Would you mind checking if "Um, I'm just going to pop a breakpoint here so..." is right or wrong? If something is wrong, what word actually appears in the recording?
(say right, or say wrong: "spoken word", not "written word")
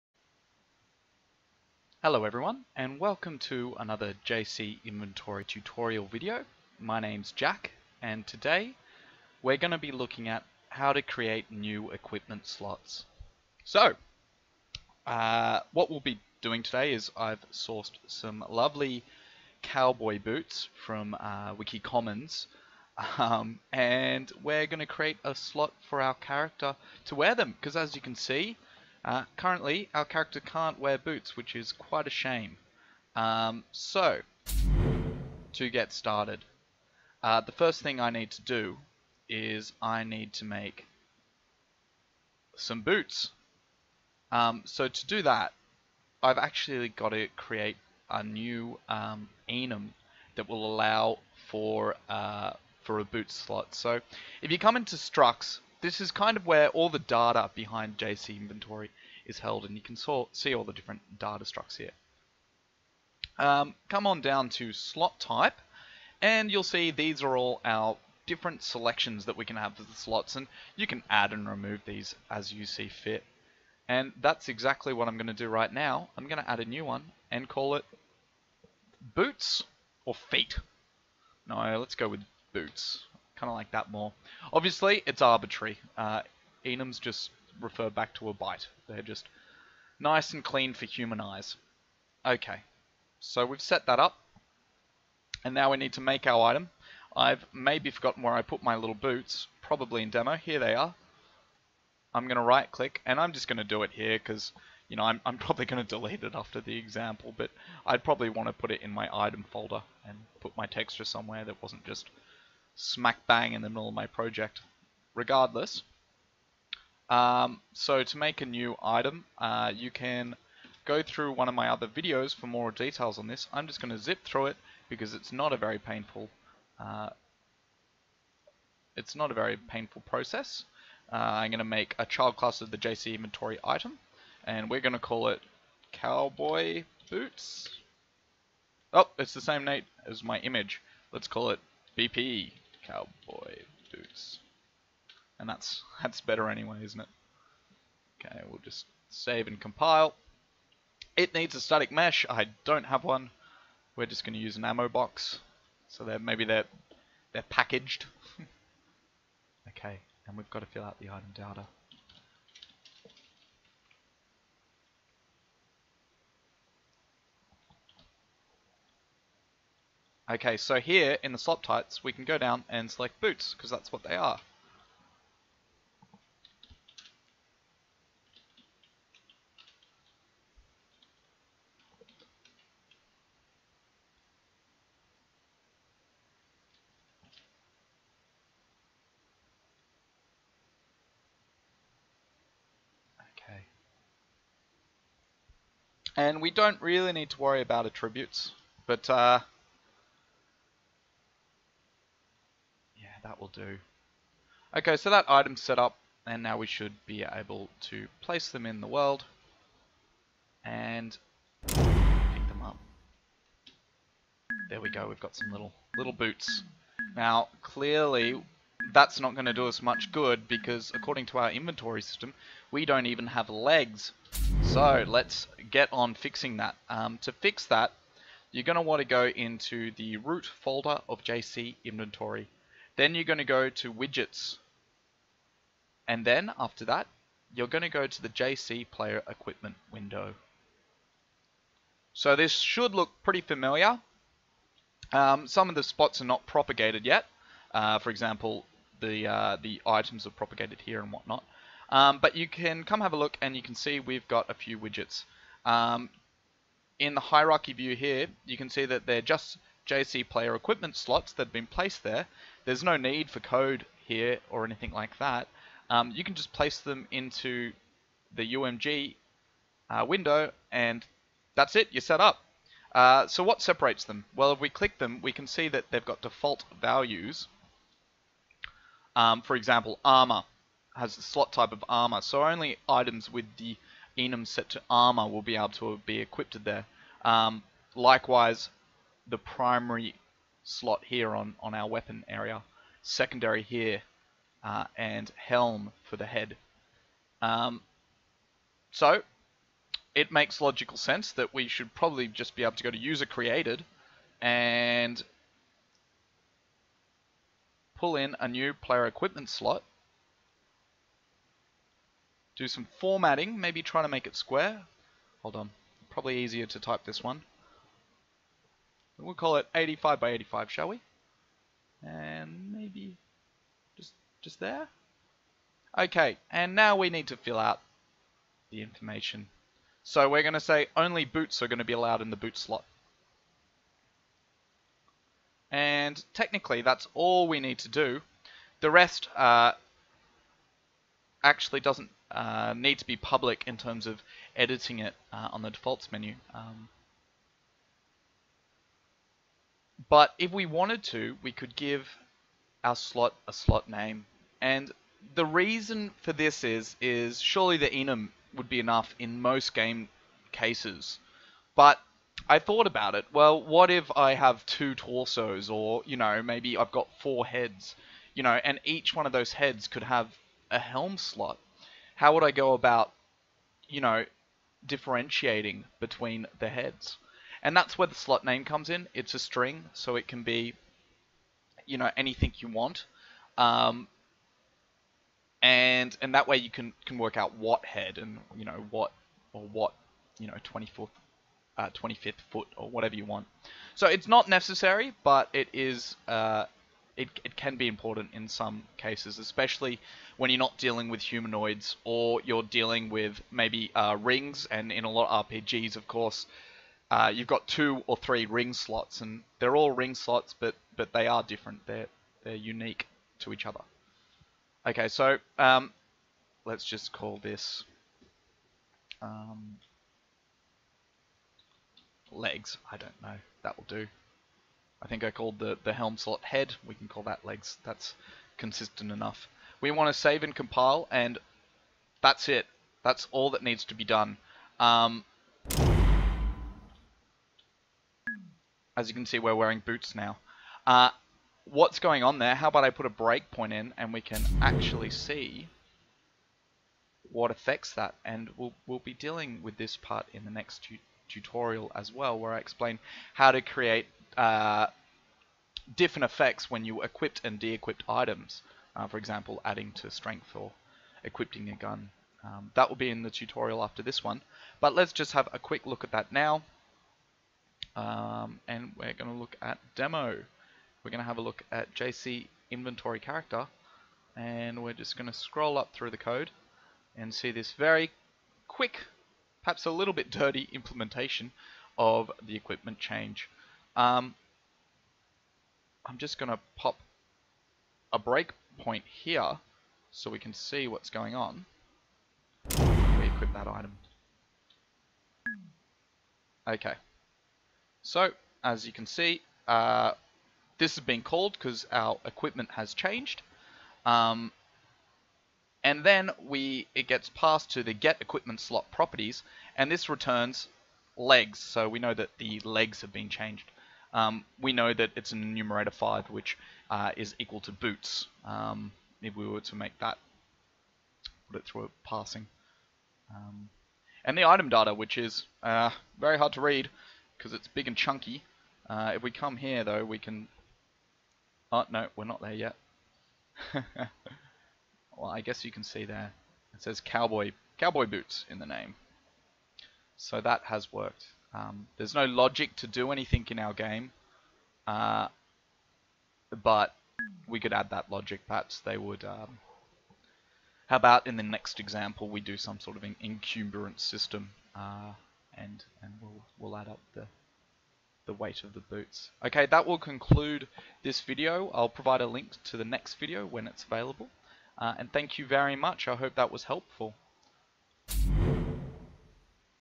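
right.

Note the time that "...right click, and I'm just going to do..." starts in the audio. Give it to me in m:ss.
1:42.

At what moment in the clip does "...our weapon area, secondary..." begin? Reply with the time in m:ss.
4:51.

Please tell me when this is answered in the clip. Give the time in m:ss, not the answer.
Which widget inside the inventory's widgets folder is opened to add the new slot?
3:58.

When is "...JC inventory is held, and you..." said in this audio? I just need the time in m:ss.
0:57.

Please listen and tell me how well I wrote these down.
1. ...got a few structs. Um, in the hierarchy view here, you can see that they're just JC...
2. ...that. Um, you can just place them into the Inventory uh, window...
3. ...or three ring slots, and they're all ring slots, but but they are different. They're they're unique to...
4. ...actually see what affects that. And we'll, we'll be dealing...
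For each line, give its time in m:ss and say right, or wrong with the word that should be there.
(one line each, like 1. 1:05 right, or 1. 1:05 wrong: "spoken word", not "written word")
1. 4:14 wrong: "widgets", not "structs"
2. 4:25 wrong: "UMG", not "Inventory"
3. 6:48 right
4. 7:24 right.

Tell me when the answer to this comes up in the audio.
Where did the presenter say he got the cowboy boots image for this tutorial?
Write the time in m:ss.
0:21.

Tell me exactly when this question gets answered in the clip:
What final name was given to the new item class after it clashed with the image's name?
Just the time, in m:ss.
2:21.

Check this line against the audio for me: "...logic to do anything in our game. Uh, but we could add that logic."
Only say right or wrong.
right.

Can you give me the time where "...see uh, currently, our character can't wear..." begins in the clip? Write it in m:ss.
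0:28.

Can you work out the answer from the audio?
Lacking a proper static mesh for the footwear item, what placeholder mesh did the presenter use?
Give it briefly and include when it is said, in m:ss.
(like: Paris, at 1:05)
ammo box, at 2:34.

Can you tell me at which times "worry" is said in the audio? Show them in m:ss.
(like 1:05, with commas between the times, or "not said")
3:17.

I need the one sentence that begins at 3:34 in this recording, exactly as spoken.
There we go, we've got some little little boots.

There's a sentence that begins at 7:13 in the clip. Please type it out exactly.
That's all that needs to be done.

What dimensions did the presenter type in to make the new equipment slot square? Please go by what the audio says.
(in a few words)
85 by 85.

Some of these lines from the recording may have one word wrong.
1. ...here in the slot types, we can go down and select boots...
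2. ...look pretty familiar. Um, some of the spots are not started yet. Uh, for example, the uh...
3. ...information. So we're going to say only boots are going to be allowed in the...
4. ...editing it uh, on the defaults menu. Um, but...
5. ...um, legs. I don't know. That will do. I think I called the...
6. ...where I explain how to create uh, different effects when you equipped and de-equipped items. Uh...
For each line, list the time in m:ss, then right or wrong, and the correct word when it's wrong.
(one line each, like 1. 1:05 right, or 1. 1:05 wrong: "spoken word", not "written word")
1. 2:50 right
2. 4:02 wrong: "propagated", not "started"
3. 5:28 right
4. 5:44 right
5. 6:59 right
6. 7:32 right.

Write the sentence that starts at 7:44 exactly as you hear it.
But let's just have a quick look at that now um, and we're going to look at demo.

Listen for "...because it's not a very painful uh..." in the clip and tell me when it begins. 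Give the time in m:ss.
2:04.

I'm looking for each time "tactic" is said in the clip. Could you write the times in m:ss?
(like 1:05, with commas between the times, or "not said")
not said.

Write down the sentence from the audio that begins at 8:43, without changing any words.
Um, and the item data, which is uh, very hard to read, because it's big and chunky.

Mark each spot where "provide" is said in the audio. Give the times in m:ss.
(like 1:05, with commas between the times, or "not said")
9:21.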